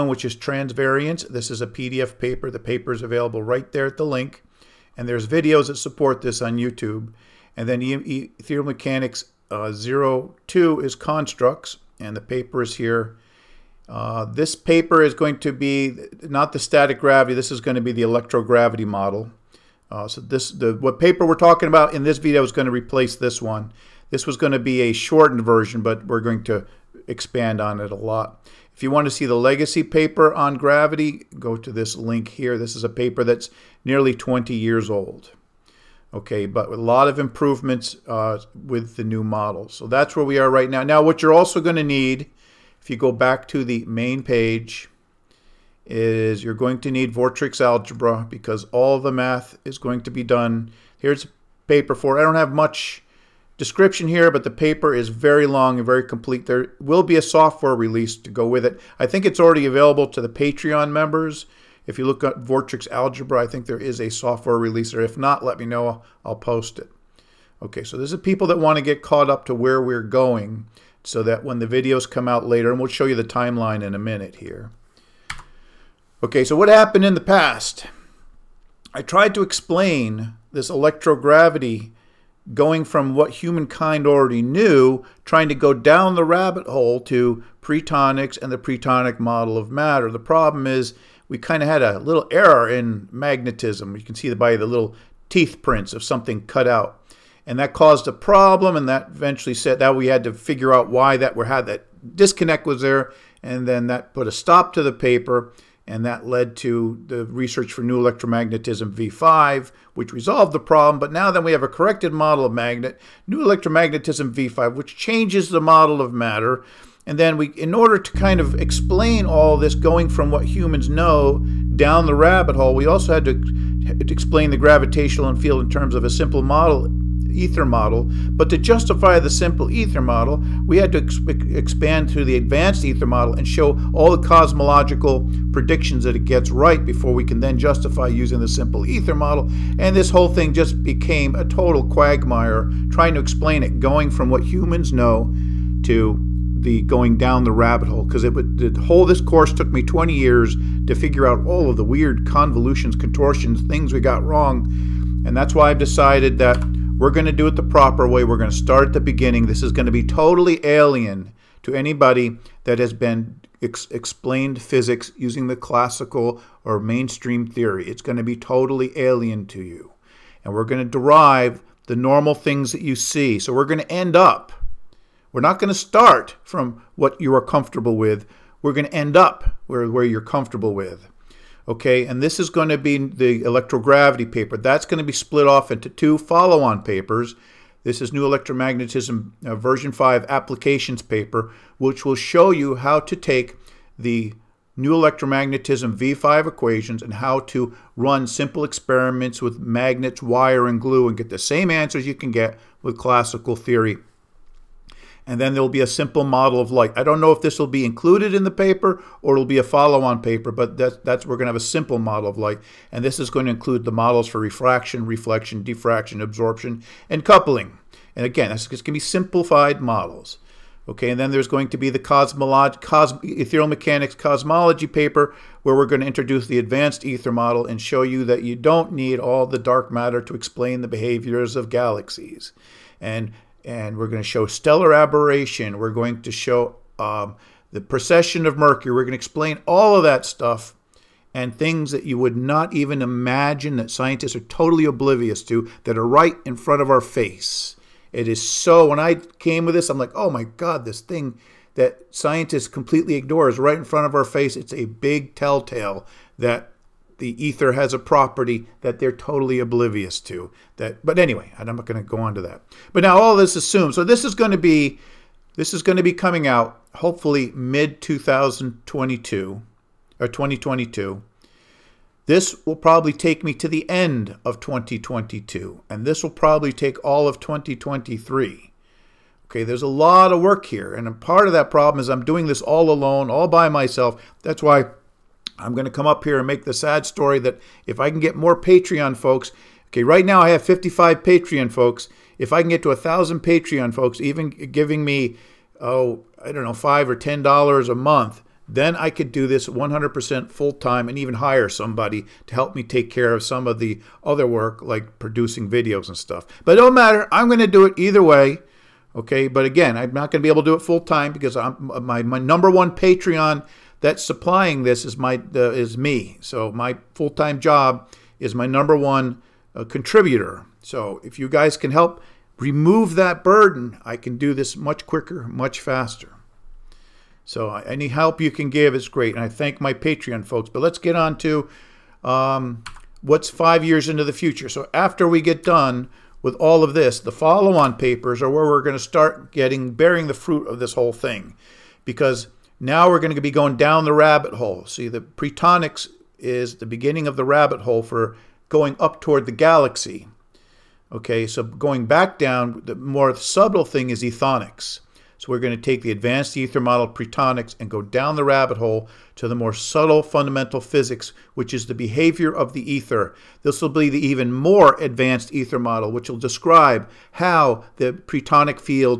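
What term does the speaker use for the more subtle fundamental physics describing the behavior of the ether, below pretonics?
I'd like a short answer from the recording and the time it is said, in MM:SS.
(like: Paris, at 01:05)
ethonics, at 05:54.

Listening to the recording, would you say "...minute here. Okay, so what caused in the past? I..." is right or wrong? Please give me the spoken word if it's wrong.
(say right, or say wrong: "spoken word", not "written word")
wrong: "happened", not "caused".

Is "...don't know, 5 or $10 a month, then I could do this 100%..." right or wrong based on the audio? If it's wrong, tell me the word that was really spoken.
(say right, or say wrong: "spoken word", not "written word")
right.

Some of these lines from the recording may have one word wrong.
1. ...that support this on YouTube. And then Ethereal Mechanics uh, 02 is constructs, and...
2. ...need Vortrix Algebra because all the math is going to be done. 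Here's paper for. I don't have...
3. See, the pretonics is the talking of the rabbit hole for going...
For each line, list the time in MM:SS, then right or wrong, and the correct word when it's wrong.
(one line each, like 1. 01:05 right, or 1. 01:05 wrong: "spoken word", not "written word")
1. 00:05 right
2. 00:46 right
3. 05:44 wrong: "beginning", not "talking".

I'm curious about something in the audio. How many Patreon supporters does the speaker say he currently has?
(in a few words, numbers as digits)
55.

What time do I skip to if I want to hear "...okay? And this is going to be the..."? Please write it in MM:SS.
03:01.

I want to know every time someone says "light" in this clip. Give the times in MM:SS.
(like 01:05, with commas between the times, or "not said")
03:26, 03:32.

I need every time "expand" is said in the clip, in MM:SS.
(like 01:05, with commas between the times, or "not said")
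00:27, 02:11.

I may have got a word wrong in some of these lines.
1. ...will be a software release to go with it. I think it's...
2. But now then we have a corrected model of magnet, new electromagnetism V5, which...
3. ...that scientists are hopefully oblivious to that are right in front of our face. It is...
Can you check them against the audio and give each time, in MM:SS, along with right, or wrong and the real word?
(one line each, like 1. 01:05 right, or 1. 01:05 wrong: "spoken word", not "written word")
1. 00:56 right
2. 01:50 right
3. 04:03 wrong: "totally", not "hopefully".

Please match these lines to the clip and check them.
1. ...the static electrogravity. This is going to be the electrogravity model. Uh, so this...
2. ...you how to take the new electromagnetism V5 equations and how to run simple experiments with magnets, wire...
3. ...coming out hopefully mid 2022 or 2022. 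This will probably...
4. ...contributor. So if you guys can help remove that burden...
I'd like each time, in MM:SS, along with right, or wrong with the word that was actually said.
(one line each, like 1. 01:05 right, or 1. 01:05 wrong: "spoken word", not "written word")
1. 00:16 wrong: "gravity", not "electrogravity"
2. 03:12 right
3. 04:26 right
4. 05:19 right.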